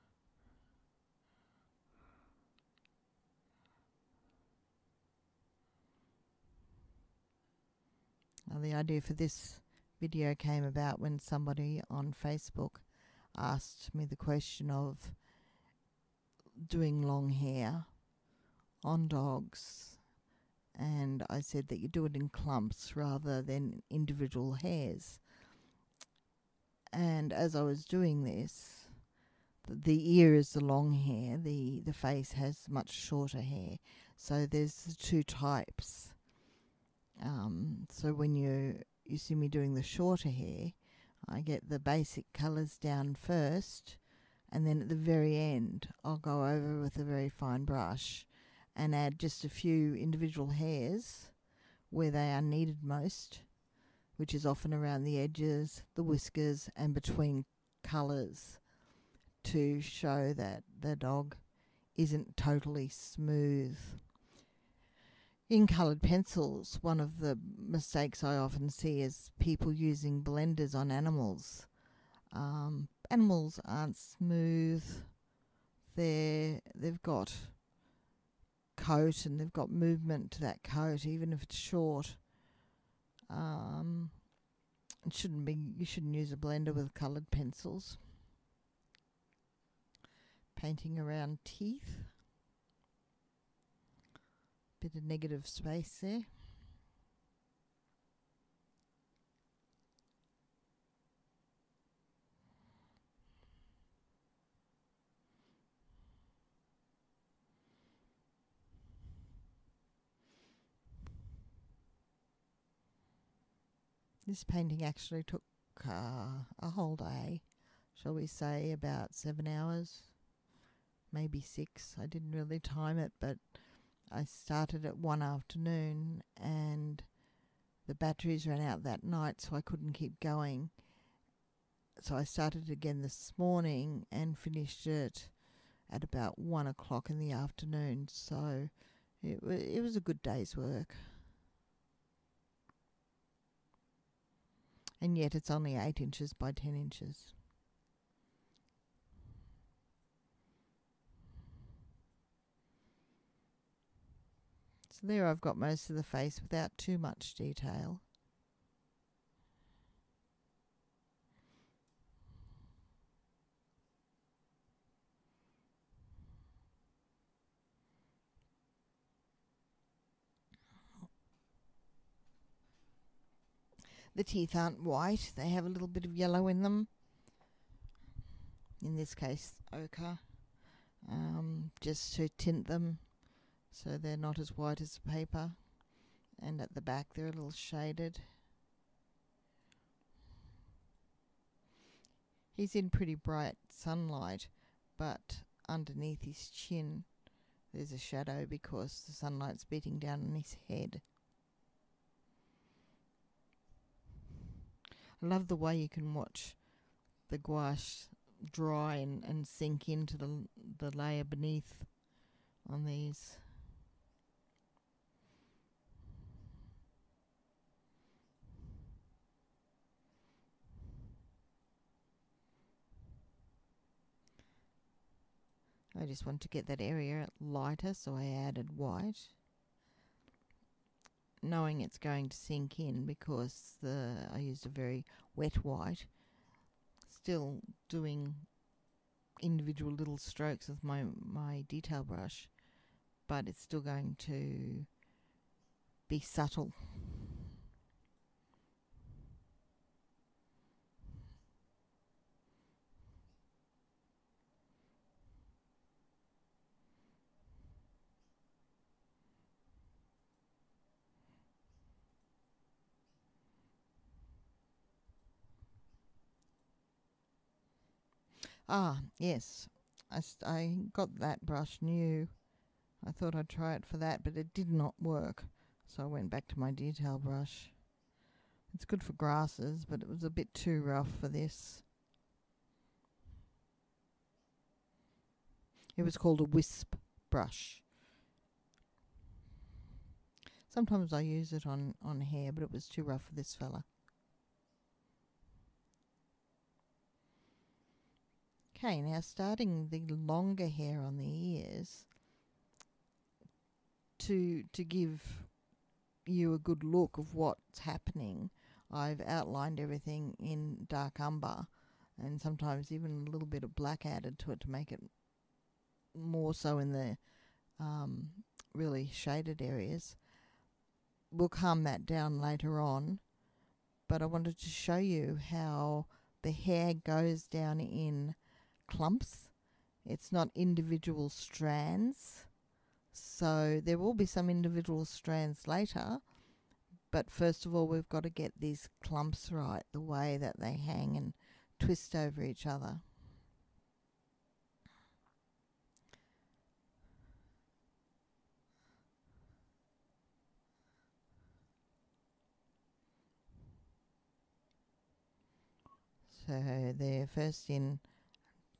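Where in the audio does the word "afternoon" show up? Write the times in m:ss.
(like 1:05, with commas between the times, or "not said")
2:05, 2:17.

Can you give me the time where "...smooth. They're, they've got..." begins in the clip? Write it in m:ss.
1:13.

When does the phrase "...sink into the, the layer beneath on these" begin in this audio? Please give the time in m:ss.
3:29.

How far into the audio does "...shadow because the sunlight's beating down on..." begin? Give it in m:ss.
3:17.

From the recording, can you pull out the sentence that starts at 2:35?
So there I've got most of the face without too much detail.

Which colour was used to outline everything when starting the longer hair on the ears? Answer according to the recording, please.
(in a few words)
dark umber.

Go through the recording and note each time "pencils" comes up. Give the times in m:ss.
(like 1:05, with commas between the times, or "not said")
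1:06, 1:27.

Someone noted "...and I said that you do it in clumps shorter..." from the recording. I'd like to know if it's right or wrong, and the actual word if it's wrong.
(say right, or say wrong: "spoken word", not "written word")
wrong: "rather", not "shorter".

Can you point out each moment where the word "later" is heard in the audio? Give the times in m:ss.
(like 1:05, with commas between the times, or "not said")
5:22, 5:35.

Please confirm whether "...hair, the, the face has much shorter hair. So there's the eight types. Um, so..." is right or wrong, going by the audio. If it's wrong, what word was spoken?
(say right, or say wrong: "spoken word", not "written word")
wrong: "two", not "eight".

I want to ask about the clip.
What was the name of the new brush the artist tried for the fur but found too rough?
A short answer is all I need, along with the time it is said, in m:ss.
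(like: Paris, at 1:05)
wisp brush, at 4:46.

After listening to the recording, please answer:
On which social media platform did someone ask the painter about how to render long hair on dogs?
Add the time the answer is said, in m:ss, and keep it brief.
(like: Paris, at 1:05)
Facebook, at 0:12.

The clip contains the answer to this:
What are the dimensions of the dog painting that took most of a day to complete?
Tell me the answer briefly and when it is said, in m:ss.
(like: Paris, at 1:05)
8 inches by 10 inches, at 2:25.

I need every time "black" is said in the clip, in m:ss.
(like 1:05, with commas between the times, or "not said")
5:13.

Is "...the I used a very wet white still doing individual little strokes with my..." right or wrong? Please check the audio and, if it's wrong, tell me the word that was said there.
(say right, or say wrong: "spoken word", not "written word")
right.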